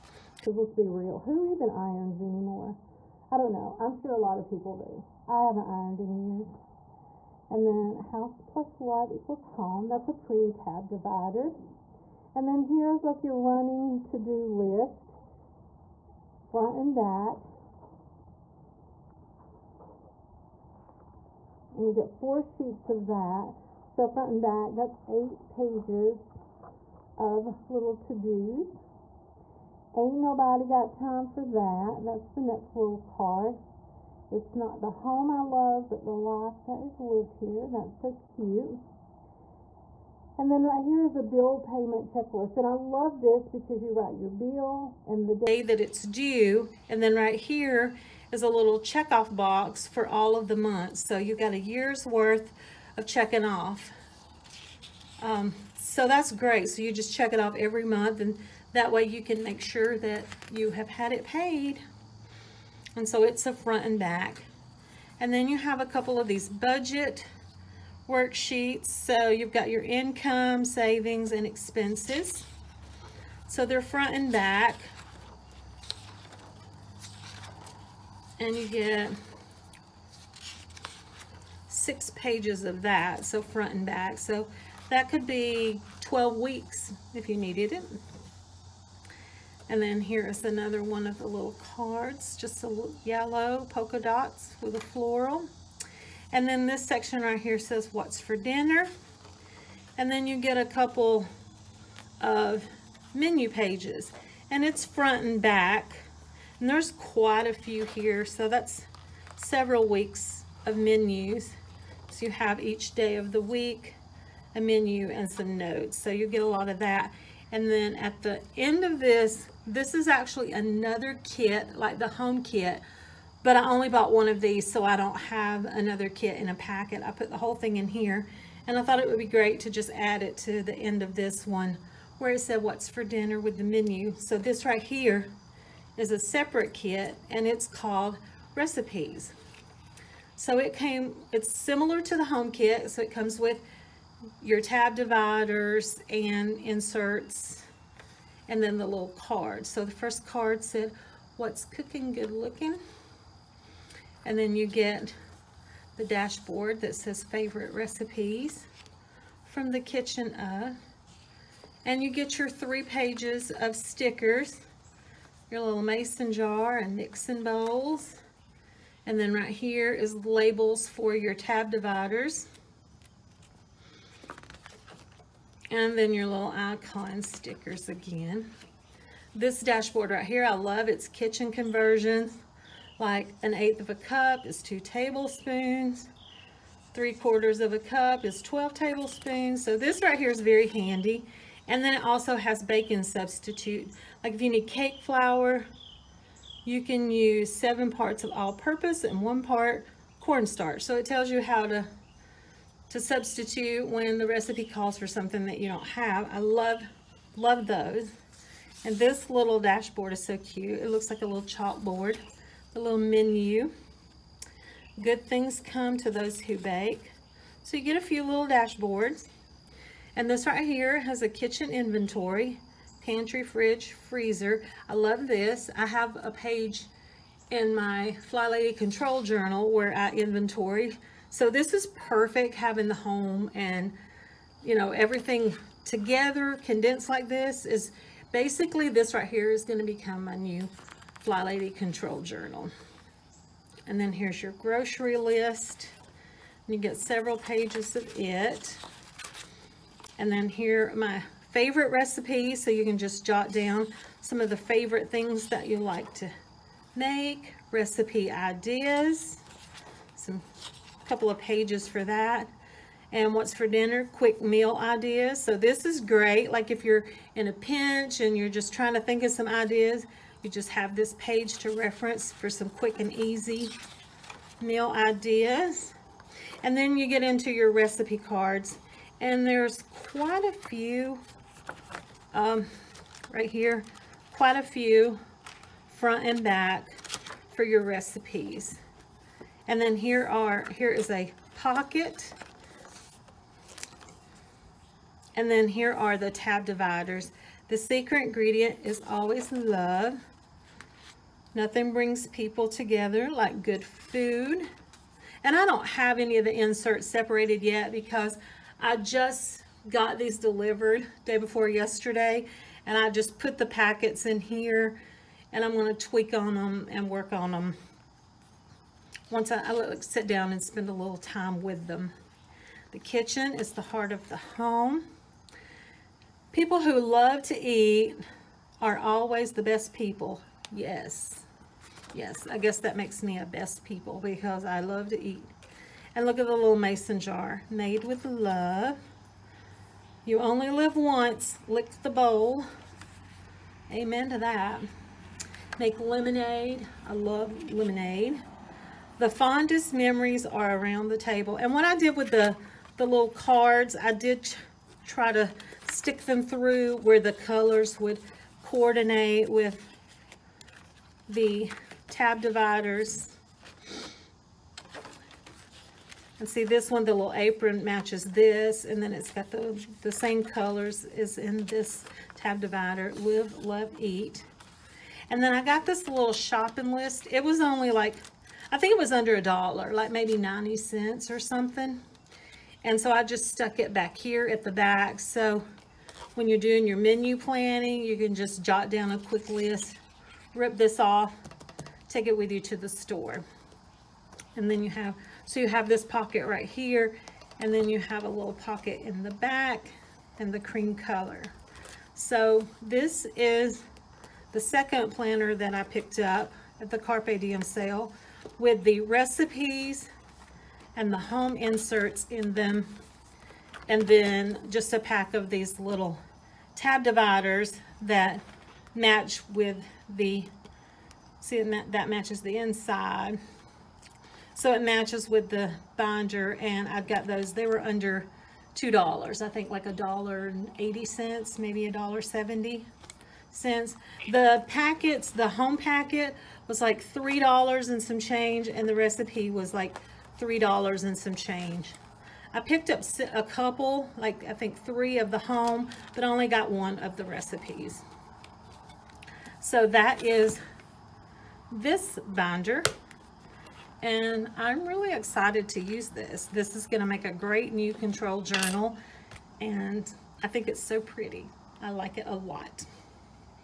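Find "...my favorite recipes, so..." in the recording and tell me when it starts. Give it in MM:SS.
04:10.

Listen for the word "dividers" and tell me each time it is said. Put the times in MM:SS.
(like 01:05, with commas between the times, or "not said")
00:10, 02:24, 02:51, 04:56, 06:02, 06:12, 06:57.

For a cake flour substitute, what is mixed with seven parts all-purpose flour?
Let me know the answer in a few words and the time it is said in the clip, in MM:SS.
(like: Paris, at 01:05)
One part cornstarch, at 03:19.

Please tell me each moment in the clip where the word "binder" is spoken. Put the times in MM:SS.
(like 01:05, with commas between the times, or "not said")
07:05, 07:32.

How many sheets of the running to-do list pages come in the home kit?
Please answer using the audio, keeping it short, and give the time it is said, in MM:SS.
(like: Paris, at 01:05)
4, at 00:22.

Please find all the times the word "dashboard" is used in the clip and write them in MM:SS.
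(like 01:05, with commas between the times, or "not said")
02:36, 02:59, 03:29, 03:38.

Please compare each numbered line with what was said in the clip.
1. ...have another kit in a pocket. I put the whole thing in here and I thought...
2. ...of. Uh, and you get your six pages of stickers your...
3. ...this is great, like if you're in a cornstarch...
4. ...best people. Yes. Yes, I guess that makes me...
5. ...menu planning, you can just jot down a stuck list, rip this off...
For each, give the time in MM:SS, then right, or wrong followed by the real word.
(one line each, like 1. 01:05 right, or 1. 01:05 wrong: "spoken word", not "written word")
1. 02:05 wrong: "packet", not "pocket"
2. 02:40 wrong: "three", not "six"
3. 04:25 wrong: "pinch", not "cornstarch"
4. 05:29 right
5. 06:26 wrong: "quick", not "stuck".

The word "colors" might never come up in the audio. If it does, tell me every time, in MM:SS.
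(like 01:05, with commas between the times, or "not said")
05:57, 06:10, 06:40.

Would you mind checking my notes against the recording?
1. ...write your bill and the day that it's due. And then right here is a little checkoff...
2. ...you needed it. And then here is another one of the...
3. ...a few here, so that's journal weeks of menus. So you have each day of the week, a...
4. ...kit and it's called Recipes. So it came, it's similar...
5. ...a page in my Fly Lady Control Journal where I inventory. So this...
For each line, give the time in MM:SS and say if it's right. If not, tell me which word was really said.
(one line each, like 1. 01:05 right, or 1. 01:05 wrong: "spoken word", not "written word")
1. 00:43 right
2. 01:27 right
3. 01:47 wrong: "several", not "journal"
4. 02:16 right
5. 03:46 right.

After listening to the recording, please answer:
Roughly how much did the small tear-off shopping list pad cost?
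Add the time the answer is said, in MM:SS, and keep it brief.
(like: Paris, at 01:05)
90 cents, at 06:20.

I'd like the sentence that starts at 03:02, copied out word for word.
Like an eighth of a cup is two tablespoons.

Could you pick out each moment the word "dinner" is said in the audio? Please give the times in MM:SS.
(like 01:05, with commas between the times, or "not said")
01:38, 02:13, 04:23.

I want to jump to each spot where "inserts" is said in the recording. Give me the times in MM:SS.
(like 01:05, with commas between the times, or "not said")
02:26, 05:06, 06:51.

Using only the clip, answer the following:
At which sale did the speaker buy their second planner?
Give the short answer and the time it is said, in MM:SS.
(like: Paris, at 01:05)
Carpe Diem sale, at 06:46.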